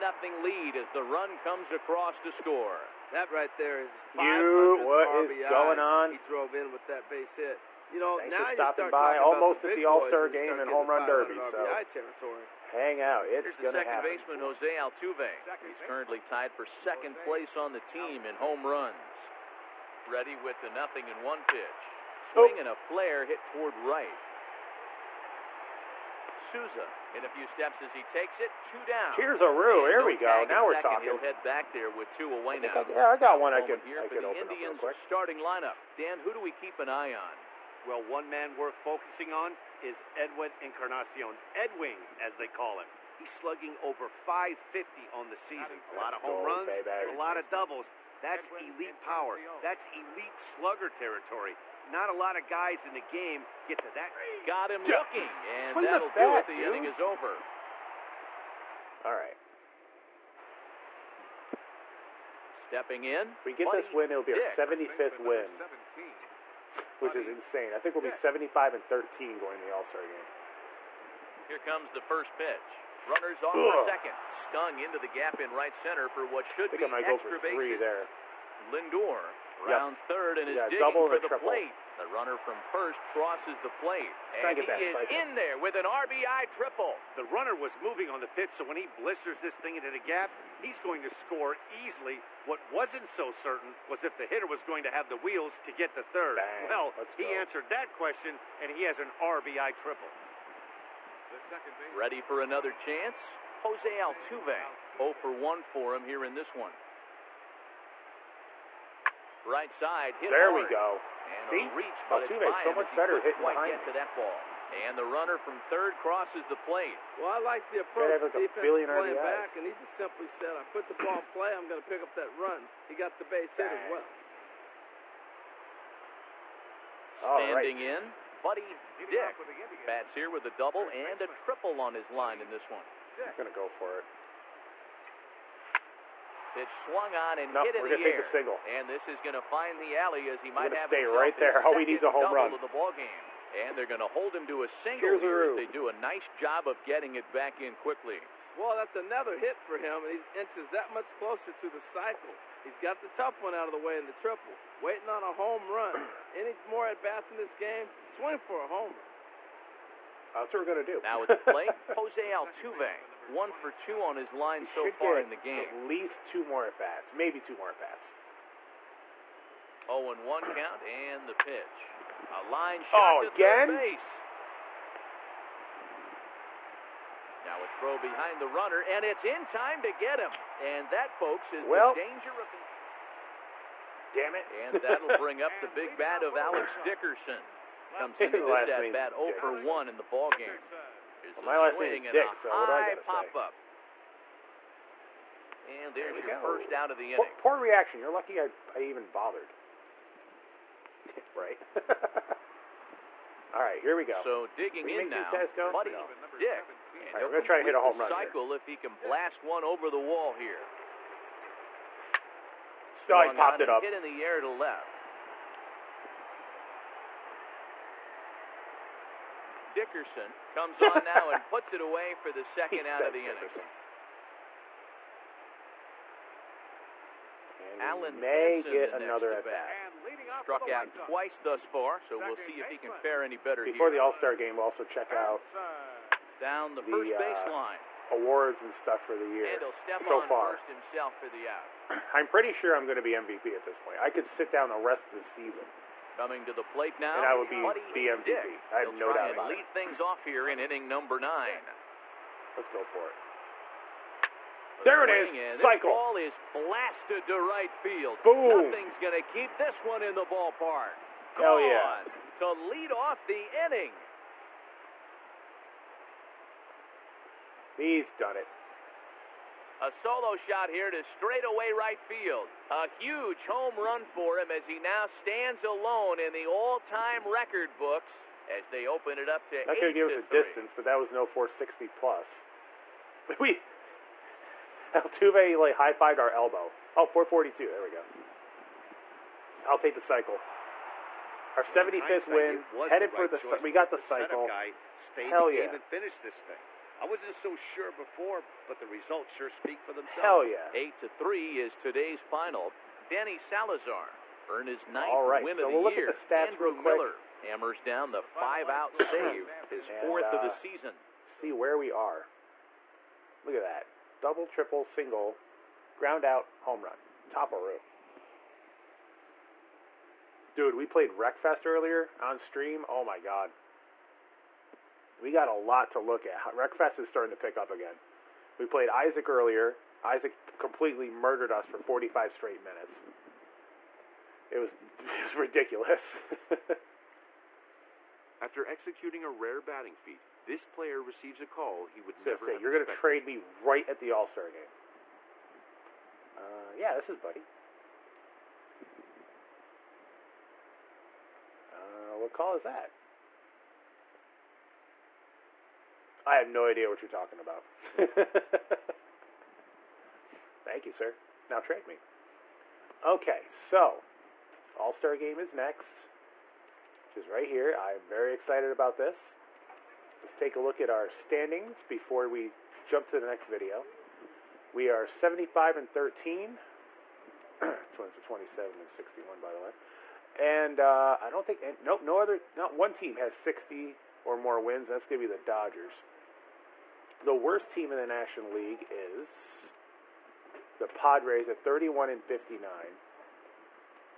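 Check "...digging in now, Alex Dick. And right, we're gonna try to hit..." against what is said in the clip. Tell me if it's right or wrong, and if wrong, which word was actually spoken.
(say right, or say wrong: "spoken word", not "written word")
wrong: "Buddy", not "Alex".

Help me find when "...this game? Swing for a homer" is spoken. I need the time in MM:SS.
02:37.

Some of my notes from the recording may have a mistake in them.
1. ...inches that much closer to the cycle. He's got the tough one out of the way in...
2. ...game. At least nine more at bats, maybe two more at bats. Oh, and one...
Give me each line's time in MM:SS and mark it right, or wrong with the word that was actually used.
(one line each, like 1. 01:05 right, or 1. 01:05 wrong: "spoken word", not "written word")
1. 02:30 right
2. 02:45 wrong: "two", not "nine".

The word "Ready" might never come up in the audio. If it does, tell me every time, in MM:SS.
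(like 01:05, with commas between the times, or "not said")
00:20, 01:41.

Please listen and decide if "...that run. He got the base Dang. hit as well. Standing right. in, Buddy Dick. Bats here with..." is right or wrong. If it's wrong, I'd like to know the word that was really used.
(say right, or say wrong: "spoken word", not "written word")
right.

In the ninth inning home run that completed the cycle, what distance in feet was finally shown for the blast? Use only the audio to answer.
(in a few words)
442.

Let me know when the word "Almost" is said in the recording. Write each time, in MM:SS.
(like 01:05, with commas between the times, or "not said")
00:09.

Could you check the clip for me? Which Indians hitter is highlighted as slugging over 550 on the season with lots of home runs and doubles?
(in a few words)
Edwin Encarnacion.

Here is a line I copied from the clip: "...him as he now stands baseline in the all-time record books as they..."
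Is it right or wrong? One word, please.
wrong.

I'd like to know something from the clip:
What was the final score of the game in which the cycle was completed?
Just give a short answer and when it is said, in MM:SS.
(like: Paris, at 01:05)
8 to 3, at 05:00.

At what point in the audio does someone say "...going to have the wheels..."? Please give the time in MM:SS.
01:34.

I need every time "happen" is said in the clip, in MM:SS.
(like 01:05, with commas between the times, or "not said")
00:13.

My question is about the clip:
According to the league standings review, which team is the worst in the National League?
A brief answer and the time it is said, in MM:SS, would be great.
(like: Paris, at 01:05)
Padres, at 06:30.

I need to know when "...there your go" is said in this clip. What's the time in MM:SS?
03:16.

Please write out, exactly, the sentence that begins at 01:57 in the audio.
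Well, I like the approach the defense playing RBIs.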